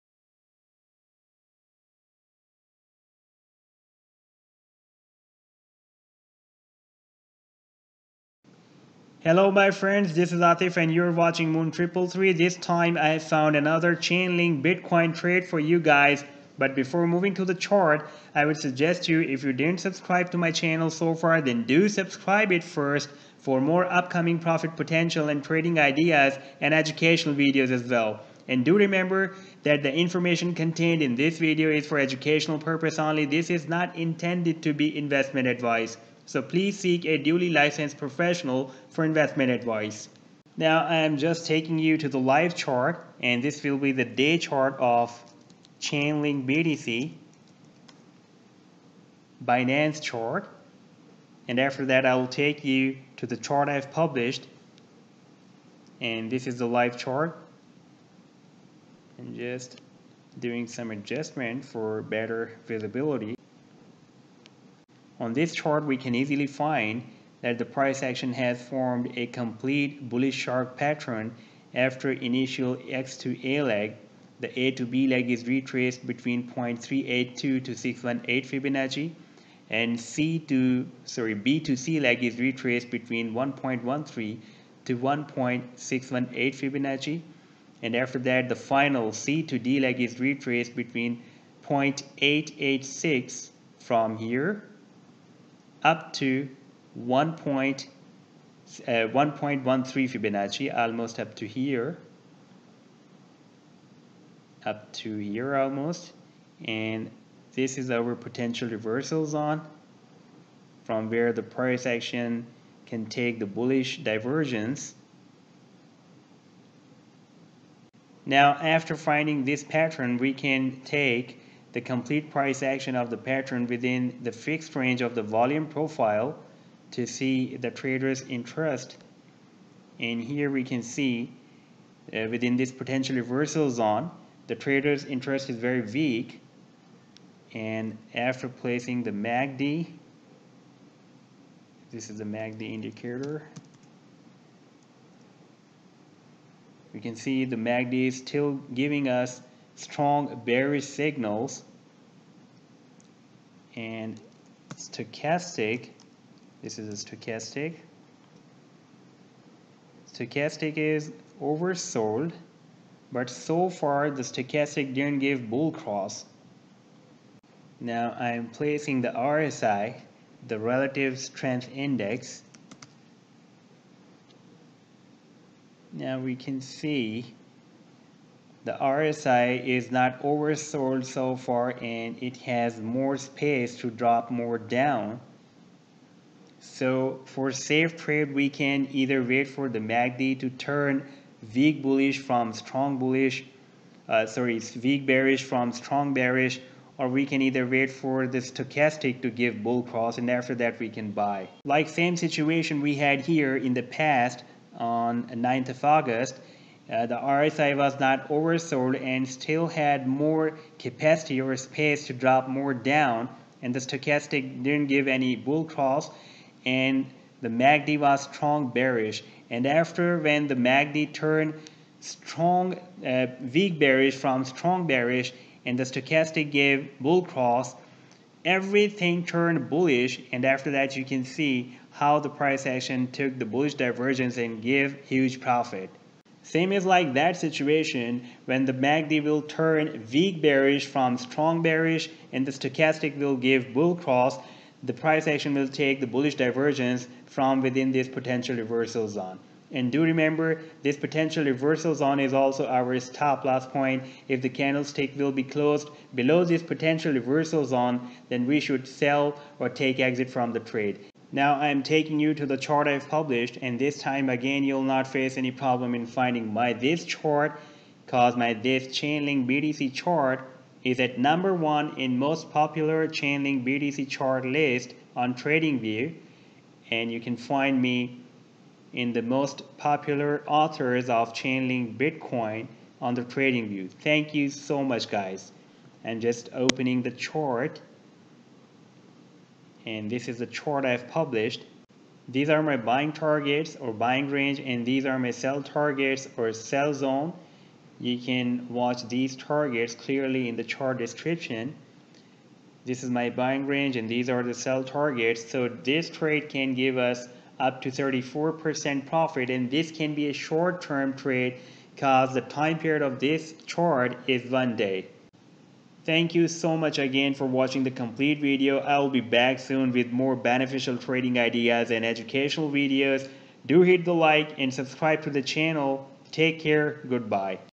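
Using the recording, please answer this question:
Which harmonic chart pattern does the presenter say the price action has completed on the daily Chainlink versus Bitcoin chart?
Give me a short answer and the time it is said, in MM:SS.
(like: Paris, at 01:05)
bullish shark pattern, at 01:10.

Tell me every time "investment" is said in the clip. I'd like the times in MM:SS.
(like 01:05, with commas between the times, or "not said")
00:34, 00:39.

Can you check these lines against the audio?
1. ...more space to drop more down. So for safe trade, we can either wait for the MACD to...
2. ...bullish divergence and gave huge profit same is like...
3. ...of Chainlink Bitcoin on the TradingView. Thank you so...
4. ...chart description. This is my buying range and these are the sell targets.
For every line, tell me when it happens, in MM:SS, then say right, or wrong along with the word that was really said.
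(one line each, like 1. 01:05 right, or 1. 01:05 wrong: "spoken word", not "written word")
1. 03:02 right
2. 03:53 right
3. 04:41 right
4. 05:00 right.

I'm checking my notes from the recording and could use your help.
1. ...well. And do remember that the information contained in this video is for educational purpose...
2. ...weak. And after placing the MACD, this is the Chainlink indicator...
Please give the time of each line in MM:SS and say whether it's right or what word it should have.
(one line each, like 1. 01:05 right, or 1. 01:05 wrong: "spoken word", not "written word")
1. 00:27 right
2. 02:15 wrong: "MACD", not "Chainlink".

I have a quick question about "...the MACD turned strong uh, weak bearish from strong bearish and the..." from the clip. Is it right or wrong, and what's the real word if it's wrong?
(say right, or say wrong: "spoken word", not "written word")
right.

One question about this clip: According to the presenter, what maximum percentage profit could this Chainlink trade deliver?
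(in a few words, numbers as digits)
34%.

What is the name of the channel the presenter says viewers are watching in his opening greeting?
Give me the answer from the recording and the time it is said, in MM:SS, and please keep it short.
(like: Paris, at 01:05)
Moon 333, at 00:11.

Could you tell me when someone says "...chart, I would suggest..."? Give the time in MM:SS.
00:17.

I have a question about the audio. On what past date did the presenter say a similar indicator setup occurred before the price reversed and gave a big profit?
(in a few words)
9th of August.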